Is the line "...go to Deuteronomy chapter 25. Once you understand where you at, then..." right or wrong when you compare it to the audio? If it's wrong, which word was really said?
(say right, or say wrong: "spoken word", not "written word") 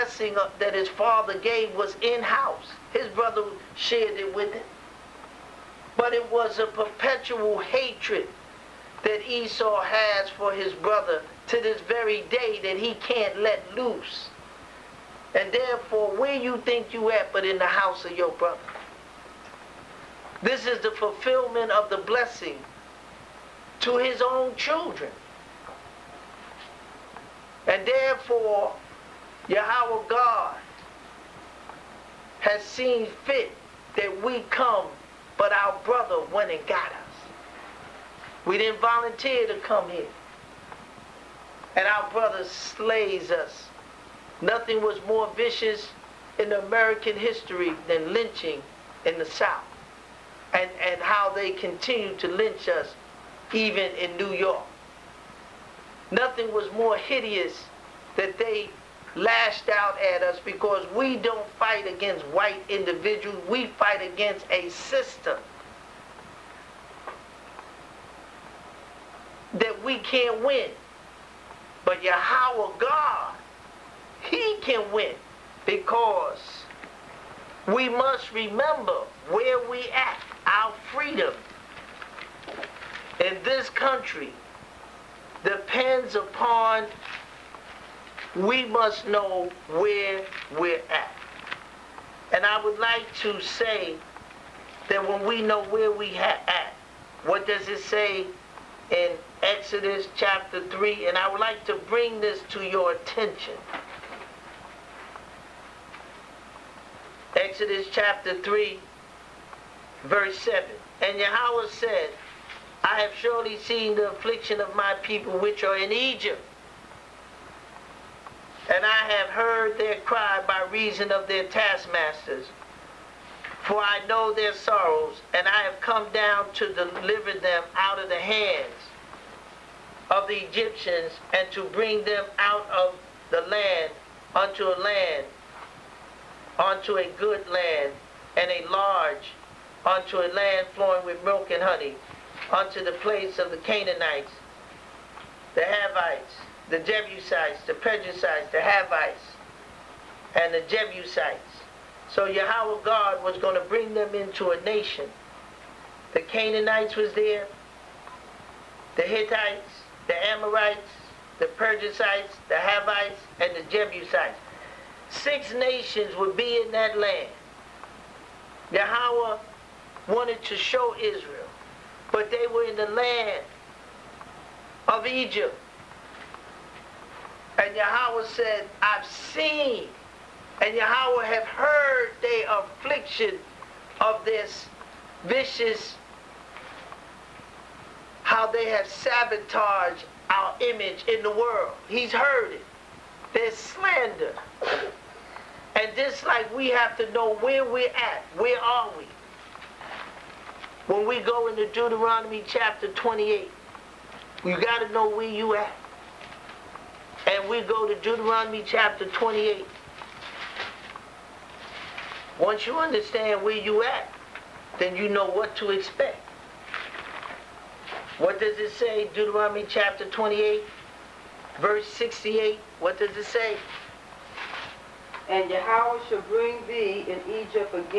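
wrong: "28", not "25".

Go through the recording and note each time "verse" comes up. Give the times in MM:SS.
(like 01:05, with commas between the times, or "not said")
01:50, 03:41.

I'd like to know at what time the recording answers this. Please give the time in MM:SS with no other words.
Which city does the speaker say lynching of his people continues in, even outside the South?
00:54.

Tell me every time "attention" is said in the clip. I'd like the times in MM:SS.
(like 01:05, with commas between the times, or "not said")
01:42.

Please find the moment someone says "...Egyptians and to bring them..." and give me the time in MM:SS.
02:10.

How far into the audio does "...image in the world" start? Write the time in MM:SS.
03:10.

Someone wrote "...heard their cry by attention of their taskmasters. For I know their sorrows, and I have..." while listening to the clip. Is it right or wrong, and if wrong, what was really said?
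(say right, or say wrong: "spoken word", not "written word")
wrong: "reason", not "attention".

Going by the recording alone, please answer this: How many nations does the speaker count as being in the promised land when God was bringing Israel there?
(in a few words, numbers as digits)
6.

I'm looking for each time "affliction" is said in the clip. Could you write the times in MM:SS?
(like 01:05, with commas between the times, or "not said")
01:54, 03:02.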